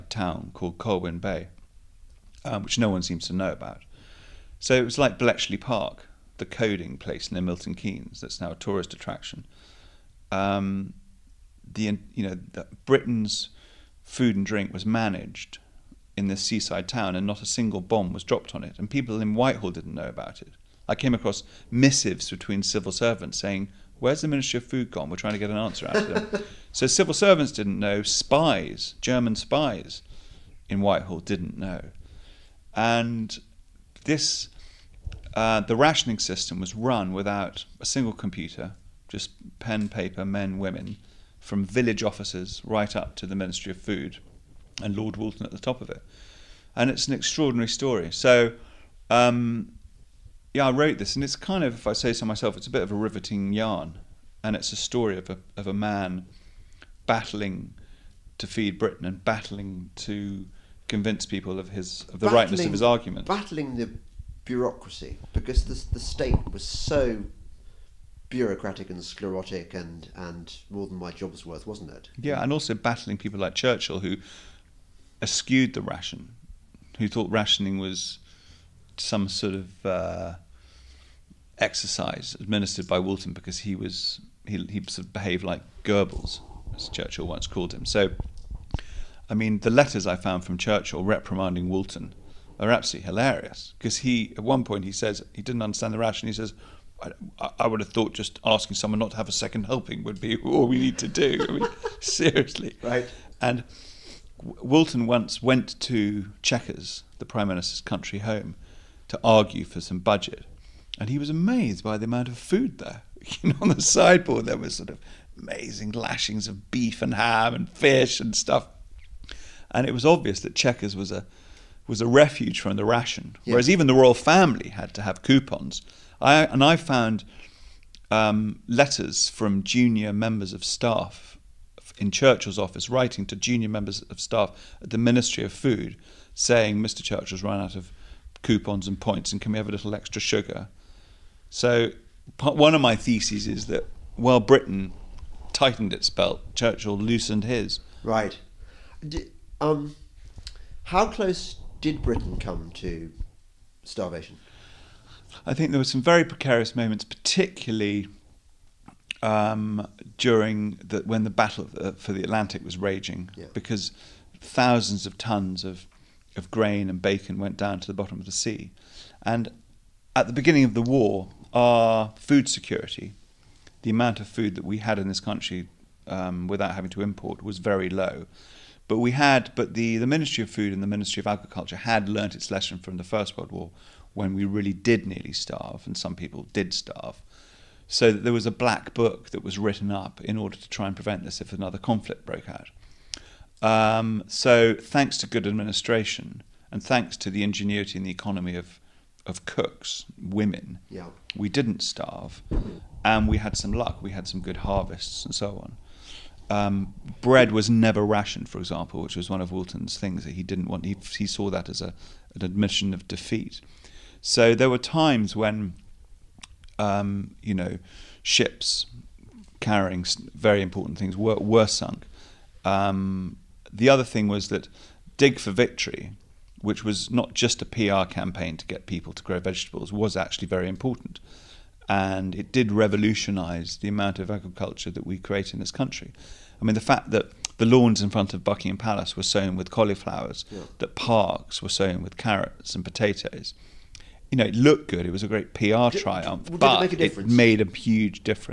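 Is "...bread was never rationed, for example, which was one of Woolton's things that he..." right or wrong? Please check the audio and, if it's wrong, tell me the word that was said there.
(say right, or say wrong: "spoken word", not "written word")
right.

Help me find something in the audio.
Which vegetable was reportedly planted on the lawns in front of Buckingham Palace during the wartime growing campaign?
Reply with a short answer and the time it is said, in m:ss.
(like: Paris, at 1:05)
Cauliflowers, at 3:59.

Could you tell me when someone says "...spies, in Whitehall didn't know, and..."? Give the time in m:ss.
0:29.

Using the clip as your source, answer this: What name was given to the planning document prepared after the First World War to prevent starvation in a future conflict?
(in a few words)
black book.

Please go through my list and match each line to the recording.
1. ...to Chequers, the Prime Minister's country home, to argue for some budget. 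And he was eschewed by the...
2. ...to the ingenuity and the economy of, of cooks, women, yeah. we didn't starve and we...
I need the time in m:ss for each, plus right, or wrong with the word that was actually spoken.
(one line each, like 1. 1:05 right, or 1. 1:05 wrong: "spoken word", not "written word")
1. 1:45 wrong: "amazed", not "eschewed"
2. 3:17 right.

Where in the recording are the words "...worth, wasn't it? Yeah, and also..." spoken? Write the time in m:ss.
1:11.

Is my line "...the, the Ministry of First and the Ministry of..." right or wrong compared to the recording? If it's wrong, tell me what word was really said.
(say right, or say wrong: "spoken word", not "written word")
wrong: "Food", not "First".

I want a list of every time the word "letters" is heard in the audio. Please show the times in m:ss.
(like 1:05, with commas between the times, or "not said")
1:29, 2:08.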